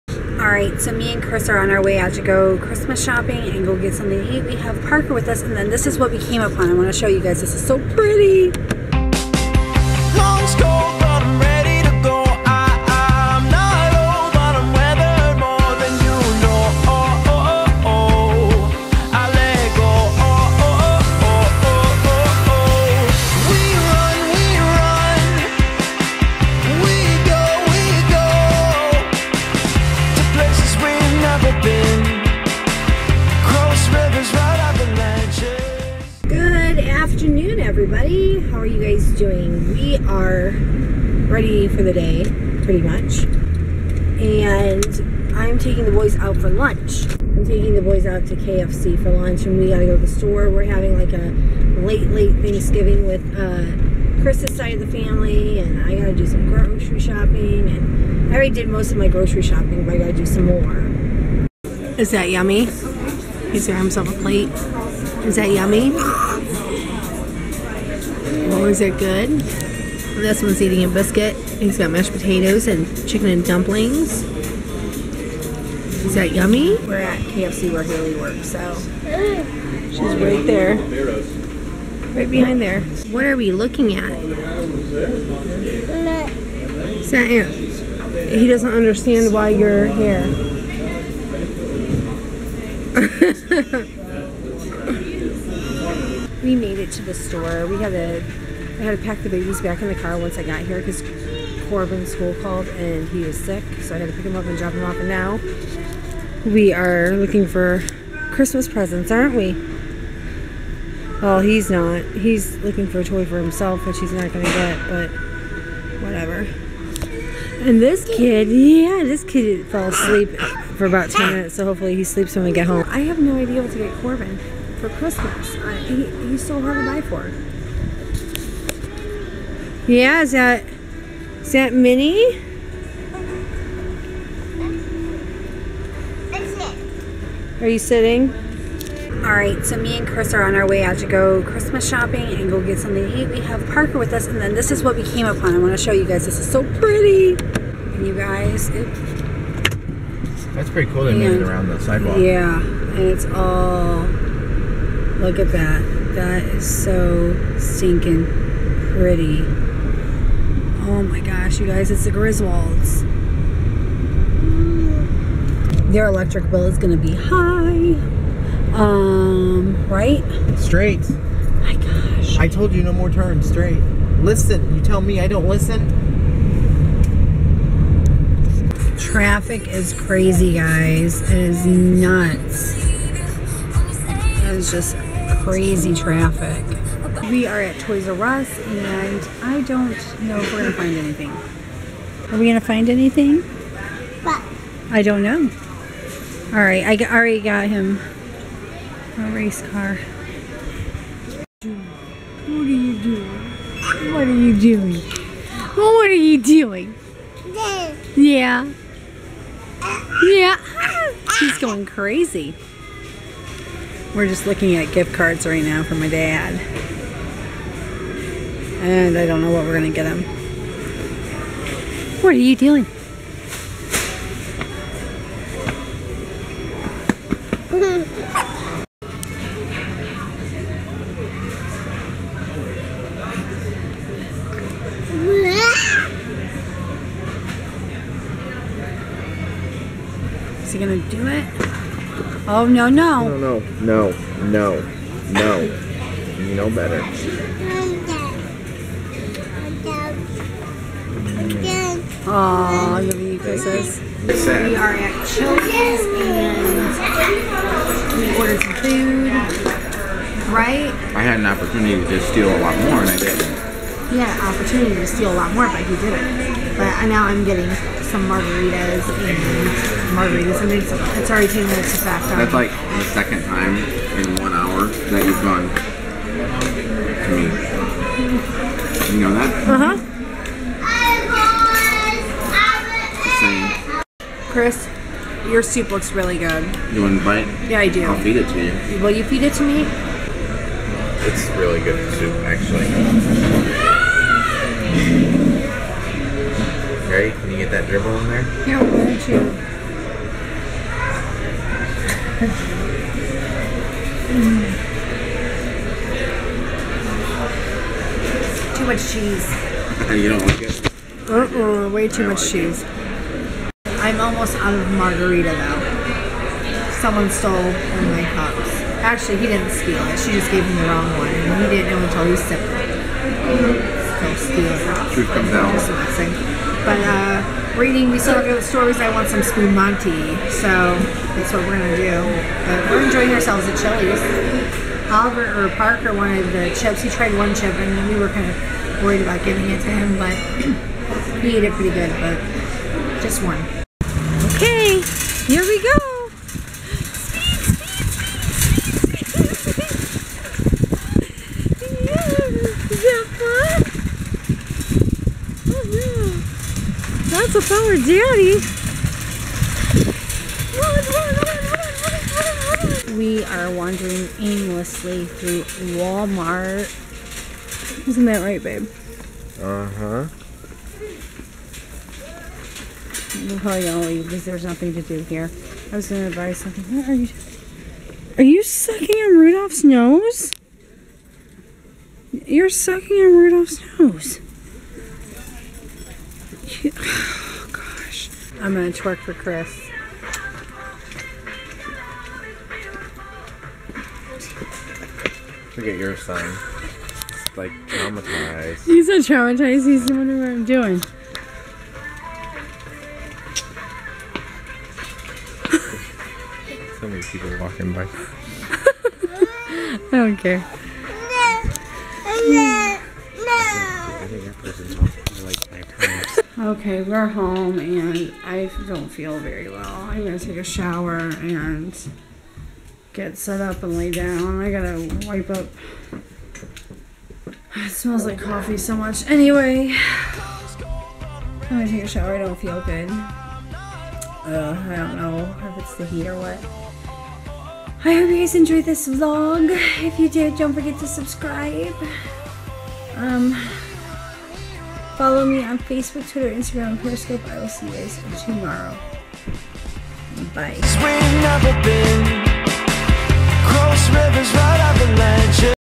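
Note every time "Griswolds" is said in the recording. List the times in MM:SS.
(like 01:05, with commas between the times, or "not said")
02:42.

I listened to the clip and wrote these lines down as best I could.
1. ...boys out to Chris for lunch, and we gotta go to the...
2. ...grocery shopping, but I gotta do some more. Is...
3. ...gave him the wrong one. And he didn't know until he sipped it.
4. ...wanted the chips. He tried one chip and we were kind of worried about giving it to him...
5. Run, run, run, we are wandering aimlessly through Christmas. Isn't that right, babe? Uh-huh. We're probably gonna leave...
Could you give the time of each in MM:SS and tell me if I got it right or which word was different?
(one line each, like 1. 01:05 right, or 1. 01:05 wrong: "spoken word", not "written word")
1. 00:47 wrong: "KFC", not "Chris"
2. 00:59 right
3. 05:20 right
4. 05:36 right
5. 06:00 wrong: "Walmart", not "Christmas".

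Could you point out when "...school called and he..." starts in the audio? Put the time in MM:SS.
01:42.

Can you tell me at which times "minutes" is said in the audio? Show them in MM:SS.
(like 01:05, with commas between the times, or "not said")
02:01, 04:31.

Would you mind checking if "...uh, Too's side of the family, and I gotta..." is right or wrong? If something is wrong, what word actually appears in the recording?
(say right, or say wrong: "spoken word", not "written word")
wrong: "Chris", not "Too".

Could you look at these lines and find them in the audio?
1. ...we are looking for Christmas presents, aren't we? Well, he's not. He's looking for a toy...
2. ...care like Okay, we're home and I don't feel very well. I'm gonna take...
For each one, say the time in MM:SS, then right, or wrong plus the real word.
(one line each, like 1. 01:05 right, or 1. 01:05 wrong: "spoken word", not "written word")
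1. 01:46 right
2. 06:50 right.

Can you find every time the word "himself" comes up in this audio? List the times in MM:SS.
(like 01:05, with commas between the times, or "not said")
01:03, 01:53.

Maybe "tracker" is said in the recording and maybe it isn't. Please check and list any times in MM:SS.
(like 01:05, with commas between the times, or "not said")
not said.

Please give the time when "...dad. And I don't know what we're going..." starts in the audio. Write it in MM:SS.
03:36.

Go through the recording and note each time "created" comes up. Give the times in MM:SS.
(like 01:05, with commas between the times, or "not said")
not said.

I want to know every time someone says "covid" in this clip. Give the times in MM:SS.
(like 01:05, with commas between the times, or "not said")
not said.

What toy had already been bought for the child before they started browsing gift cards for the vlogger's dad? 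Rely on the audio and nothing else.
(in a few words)
A race car.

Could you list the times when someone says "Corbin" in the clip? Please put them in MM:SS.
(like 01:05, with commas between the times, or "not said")
01:41, 02:04.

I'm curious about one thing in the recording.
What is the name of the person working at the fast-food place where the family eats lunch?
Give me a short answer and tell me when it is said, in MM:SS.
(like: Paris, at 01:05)
Hayley, at 01:17.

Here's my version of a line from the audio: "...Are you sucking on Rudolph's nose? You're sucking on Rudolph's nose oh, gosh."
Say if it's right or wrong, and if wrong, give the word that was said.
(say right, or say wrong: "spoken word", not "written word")
right.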